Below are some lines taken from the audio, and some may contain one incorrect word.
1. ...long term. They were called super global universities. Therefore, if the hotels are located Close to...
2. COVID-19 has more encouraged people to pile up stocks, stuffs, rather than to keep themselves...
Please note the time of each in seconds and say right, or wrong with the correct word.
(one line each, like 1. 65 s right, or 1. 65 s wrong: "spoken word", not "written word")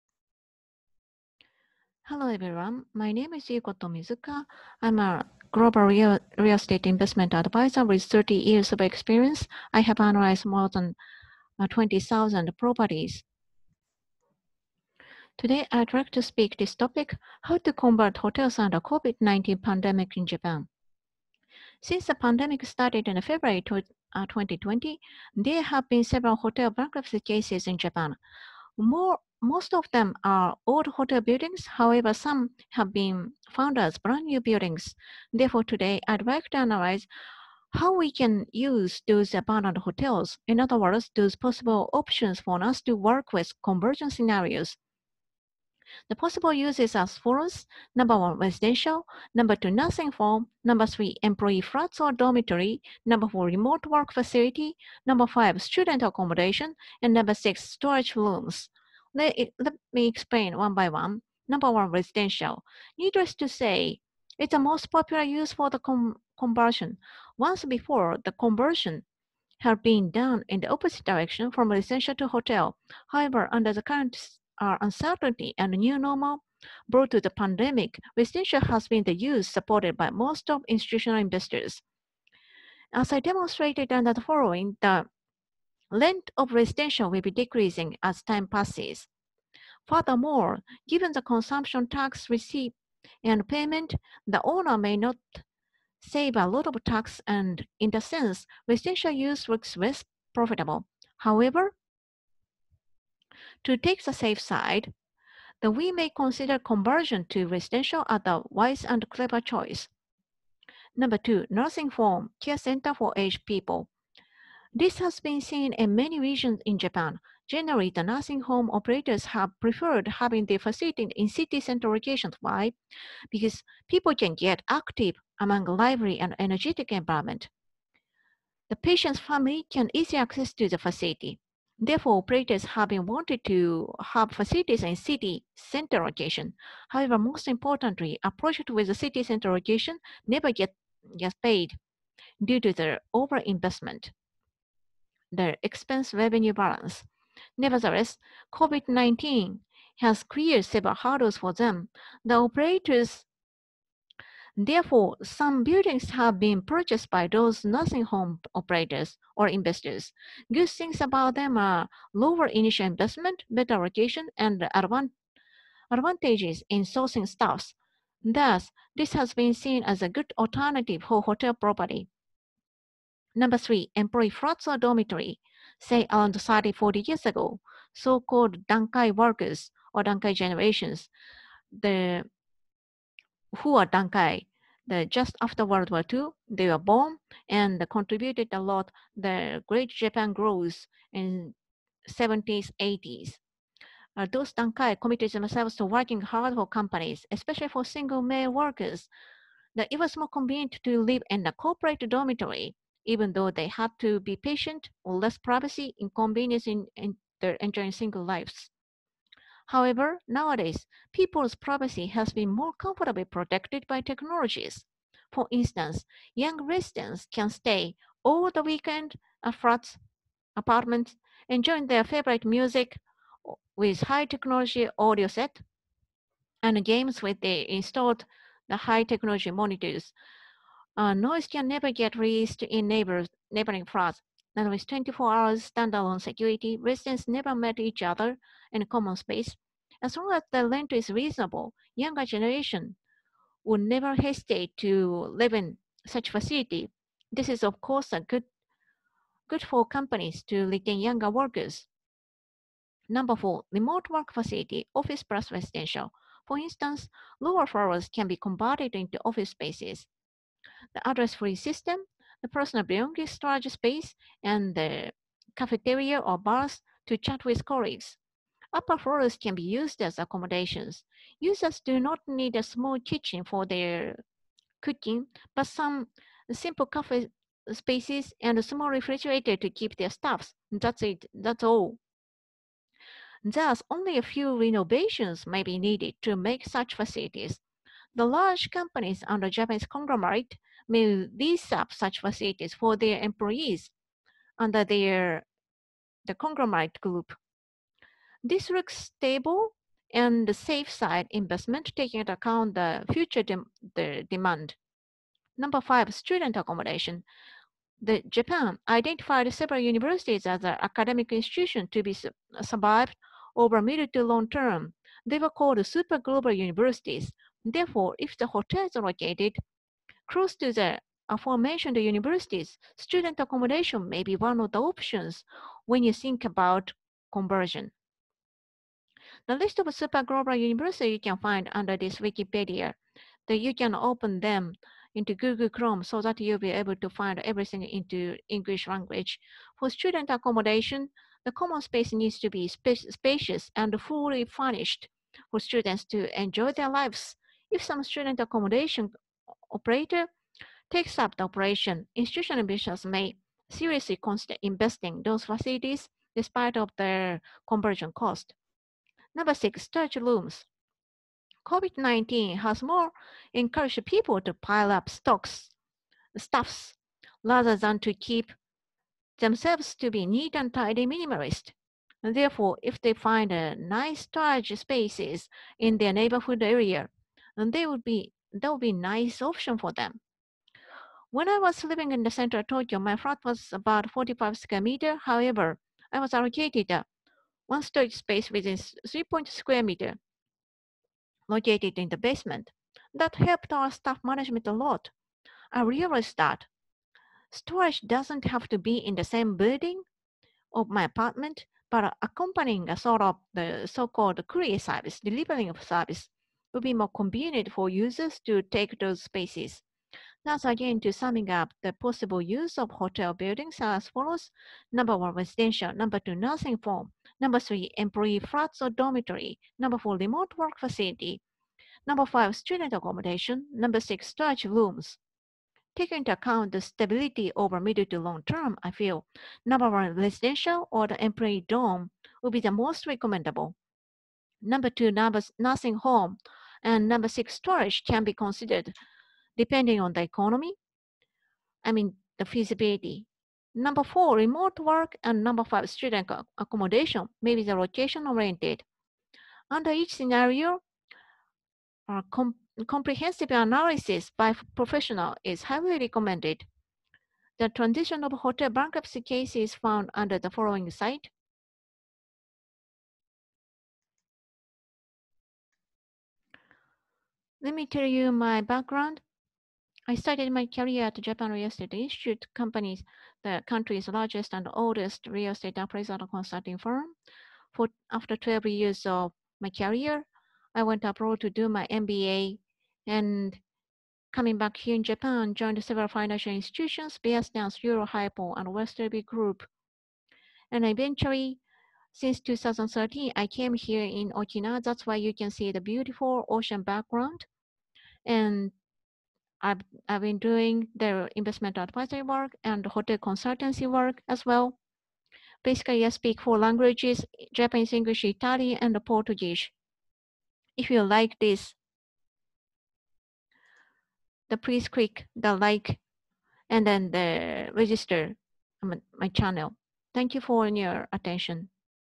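1. 314 s right
2. 361 s right.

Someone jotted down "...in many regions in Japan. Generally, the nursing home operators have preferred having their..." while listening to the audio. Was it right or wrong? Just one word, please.
right.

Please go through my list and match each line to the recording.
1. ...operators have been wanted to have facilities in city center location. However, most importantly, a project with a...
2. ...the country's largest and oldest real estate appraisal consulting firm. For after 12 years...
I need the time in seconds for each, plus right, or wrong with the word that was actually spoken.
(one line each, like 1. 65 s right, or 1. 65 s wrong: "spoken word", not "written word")
1. 132 s right
2. 473 s right.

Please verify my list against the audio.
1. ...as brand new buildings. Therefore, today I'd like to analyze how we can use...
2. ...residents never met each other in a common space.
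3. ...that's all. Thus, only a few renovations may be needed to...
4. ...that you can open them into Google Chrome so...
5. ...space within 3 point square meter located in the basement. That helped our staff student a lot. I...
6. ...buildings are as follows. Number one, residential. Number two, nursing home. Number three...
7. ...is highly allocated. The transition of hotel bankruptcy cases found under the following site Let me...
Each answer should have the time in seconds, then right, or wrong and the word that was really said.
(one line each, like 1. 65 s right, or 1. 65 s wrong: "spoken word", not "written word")
1. 33 s right
2. 236 s right
3. 281 s right
4. 333 s right
5. 388 s wrong: "management", not "student"
6. 413 s right
7. 455 s wrong: "recommended", not "allocated".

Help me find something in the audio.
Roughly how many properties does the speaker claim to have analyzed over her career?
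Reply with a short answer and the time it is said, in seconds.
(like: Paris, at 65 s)
20,000, at 11 s.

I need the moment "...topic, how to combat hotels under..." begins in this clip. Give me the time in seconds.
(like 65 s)
16 s.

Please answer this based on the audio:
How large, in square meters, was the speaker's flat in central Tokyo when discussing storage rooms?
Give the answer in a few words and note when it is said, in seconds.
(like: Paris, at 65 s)
45 square meters, at 384 s.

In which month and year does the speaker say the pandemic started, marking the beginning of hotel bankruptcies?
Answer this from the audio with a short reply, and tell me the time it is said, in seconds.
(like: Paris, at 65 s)
February 2020, at 23 s.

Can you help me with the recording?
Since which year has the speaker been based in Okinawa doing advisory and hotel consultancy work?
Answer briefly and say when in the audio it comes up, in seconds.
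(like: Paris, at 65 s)
2013, at 492 s.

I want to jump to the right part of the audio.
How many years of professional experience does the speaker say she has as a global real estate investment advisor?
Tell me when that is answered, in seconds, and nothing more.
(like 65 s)
8 s.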